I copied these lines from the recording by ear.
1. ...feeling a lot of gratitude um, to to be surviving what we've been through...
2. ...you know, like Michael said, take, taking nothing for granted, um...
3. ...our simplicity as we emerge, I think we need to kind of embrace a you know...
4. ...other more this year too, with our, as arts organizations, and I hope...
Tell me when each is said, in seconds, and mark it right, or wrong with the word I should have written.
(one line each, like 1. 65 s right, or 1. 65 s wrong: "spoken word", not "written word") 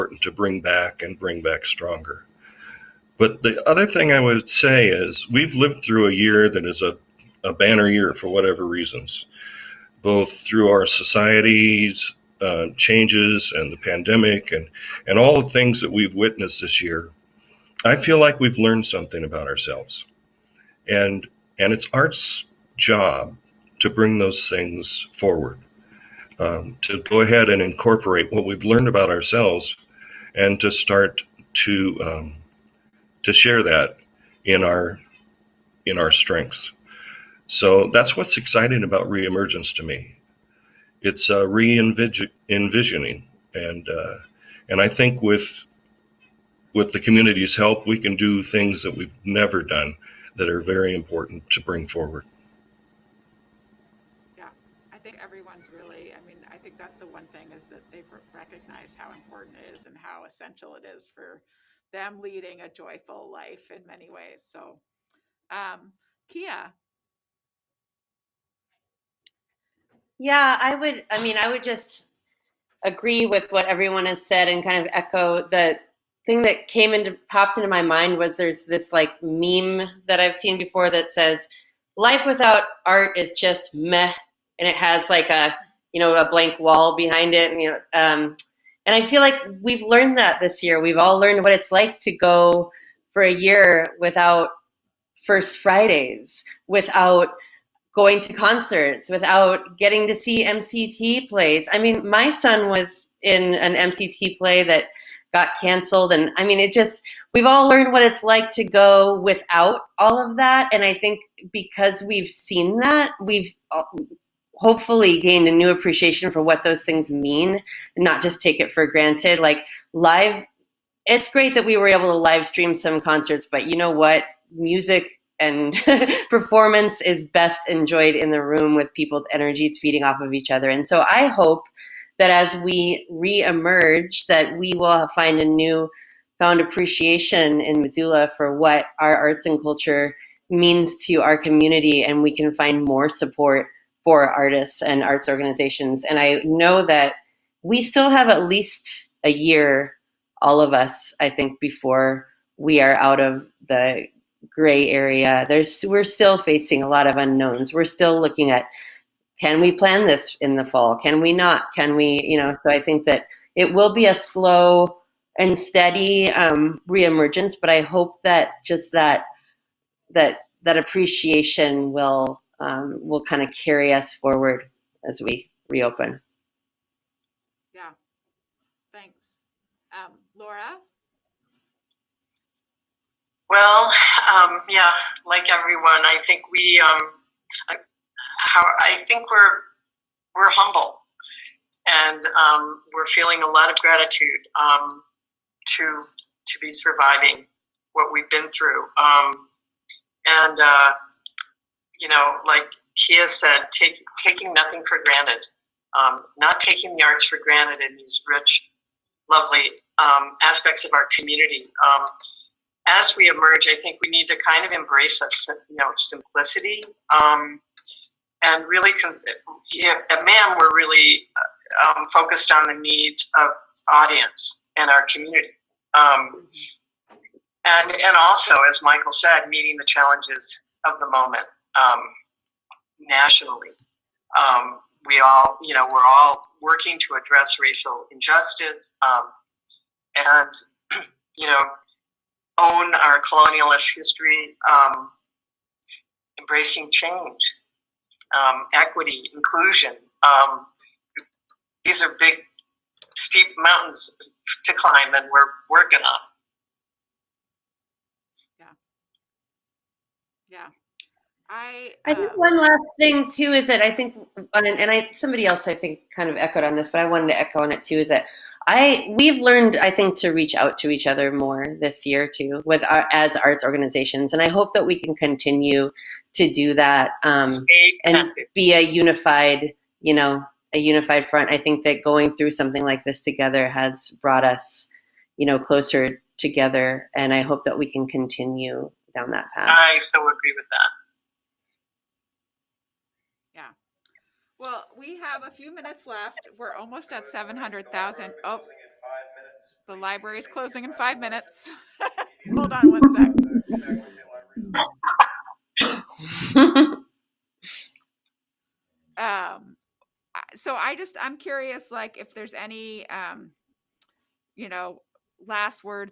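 1. 193 s right
2. 201 s wrong: "Kia", not "Michael"
3. 210 s wrong: "community", not "simplicity"
4. 271 s right.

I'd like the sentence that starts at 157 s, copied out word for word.
We're still looking at can we plan this in the fall?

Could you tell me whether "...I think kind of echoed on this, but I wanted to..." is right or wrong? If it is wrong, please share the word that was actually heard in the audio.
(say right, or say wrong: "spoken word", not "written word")
right.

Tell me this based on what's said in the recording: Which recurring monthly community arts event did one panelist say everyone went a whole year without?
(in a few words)
First Fridays.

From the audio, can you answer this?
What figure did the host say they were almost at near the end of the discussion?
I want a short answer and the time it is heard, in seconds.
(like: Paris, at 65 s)
700,000, at 297 s.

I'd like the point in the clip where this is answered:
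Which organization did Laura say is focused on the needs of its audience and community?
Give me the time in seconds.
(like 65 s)
220 s.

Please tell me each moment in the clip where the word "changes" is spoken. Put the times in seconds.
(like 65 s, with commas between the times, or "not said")
12 s, 246 s.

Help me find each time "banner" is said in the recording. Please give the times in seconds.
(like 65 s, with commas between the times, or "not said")
7 s.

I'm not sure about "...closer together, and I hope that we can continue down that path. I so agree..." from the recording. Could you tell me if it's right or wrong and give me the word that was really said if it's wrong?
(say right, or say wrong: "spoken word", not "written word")
right.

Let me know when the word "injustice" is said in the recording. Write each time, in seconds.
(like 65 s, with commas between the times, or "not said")
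238 s.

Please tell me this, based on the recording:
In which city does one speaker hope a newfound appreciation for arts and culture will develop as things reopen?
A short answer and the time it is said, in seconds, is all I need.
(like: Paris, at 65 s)
Missoula, at 137 s.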